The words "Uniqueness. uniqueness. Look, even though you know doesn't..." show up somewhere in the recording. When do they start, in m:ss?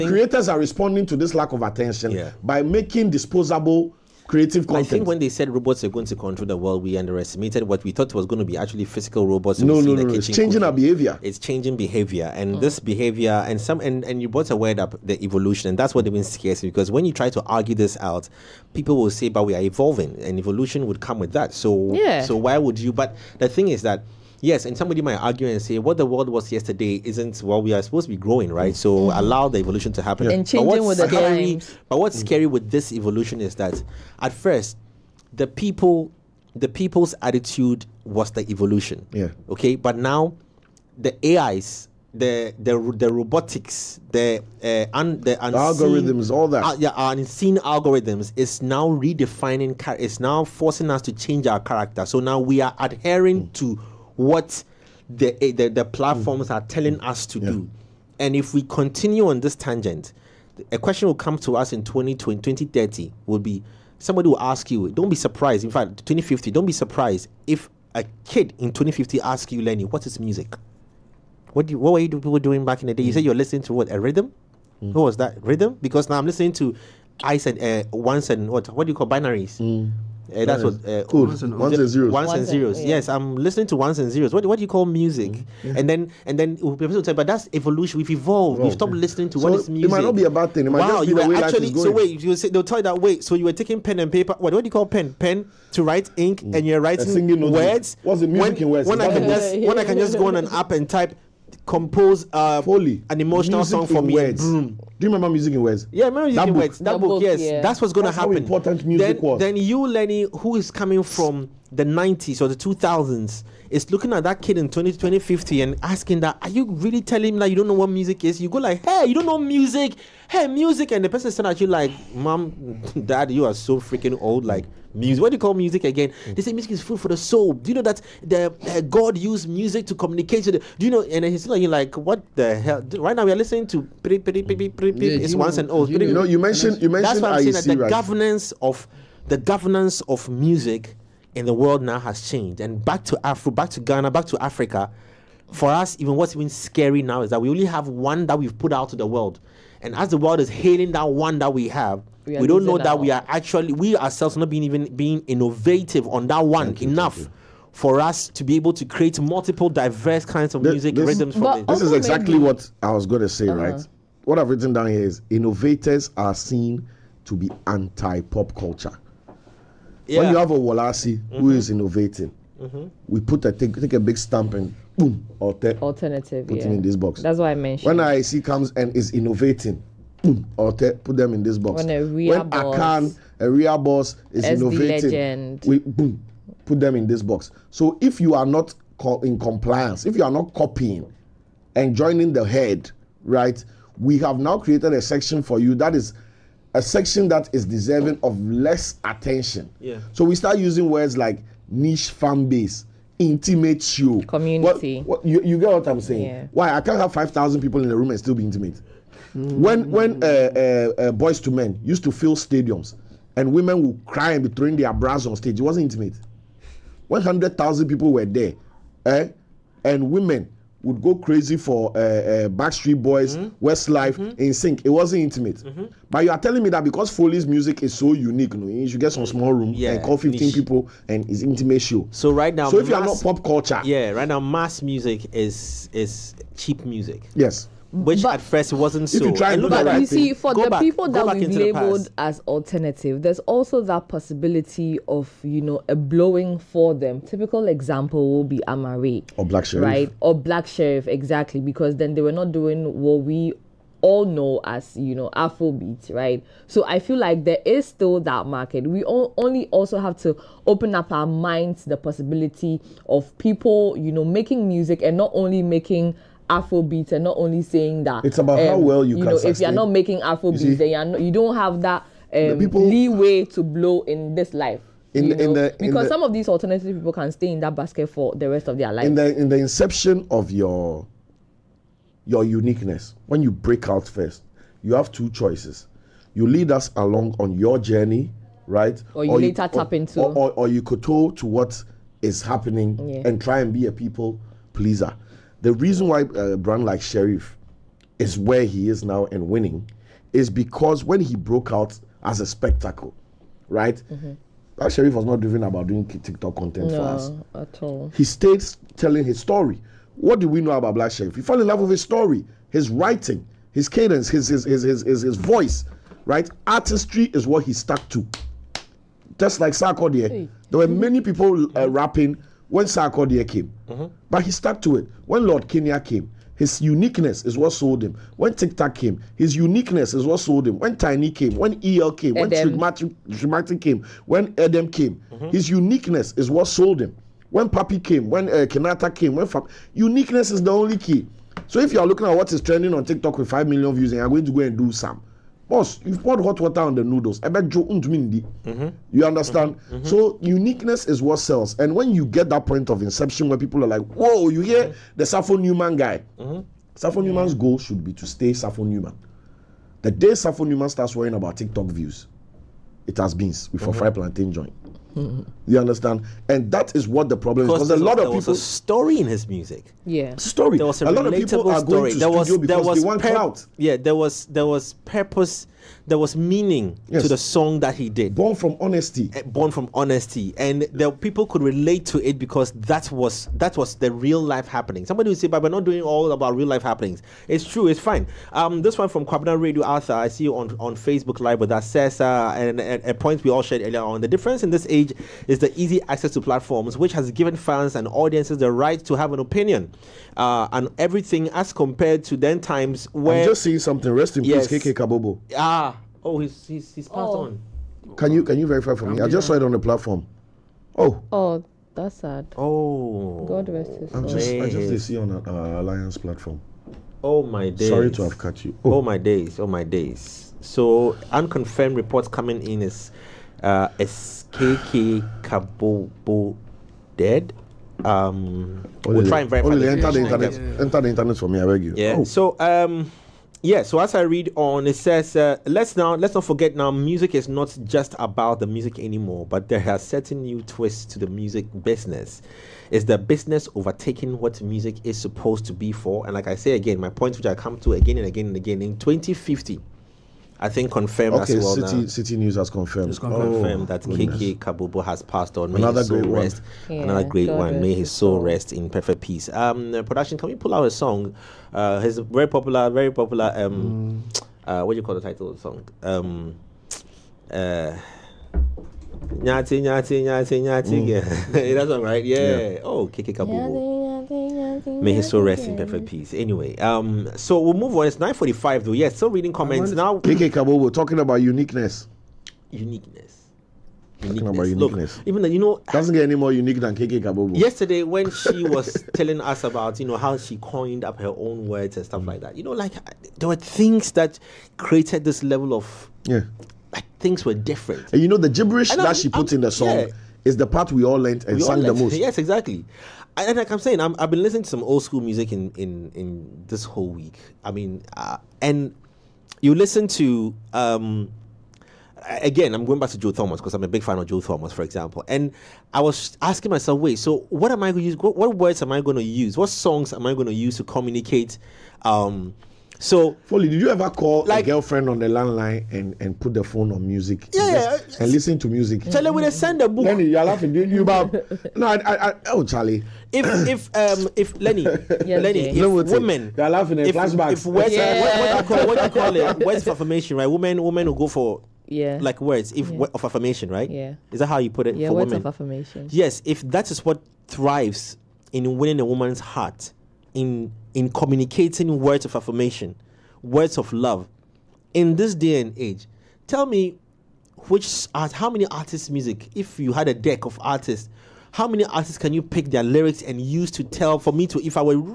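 8:04.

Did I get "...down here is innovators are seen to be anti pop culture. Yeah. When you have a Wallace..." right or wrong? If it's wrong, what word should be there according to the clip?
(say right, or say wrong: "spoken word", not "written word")
right.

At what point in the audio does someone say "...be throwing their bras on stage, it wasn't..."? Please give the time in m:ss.
3:34.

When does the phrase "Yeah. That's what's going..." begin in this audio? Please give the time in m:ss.
1:47.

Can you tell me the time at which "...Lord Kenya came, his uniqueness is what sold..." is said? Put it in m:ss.
5:25.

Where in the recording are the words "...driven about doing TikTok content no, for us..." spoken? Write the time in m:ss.
5:05.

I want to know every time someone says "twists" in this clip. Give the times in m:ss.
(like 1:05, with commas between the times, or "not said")
7:20.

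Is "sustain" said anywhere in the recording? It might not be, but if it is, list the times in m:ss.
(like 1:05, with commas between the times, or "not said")
4:29.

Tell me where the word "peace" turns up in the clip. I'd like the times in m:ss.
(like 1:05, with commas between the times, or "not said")
6:44, 7:39, 7:56.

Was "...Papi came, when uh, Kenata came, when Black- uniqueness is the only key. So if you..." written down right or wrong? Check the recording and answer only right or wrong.
wrong.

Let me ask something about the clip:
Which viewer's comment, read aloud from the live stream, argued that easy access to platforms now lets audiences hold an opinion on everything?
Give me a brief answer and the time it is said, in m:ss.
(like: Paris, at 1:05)
Kwabena Radio Arthur, at 6:29.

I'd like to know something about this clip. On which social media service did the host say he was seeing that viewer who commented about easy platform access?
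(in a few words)
Facebook Live.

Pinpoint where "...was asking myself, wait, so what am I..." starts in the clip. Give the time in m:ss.
8:36.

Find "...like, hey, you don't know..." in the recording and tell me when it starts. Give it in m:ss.
1:58.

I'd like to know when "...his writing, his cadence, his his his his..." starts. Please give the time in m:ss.
5:12.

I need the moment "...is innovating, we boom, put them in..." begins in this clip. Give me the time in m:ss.
3:04.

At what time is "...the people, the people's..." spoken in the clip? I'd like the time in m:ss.
0:35.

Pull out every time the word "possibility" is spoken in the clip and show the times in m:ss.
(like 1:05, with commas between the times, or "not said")
4:04, 4:21.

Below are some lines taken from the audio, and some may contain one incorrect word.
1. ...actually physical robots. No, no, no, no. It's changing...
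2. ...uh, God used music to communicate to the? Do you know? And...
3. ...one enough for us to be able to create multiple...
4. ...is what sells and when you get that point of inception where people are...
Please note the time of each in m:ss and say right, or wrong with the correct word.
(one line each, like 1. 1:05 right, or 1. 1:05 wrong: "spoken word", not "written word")
1. 0:08 right
2. 2:08 right
3. 2:36 right
4. 5:51 right.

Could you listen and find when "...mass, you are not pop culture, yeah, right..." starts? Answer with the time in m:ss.
3:52.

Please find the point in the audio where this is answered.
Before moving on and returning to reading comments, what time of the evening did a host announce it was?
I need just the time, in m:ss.
7:58.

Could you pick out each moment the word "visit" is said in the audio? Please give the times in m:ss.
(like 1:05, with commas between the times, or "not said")
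not said.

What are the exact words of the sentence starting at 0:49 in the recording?
is now forcing us to change our character.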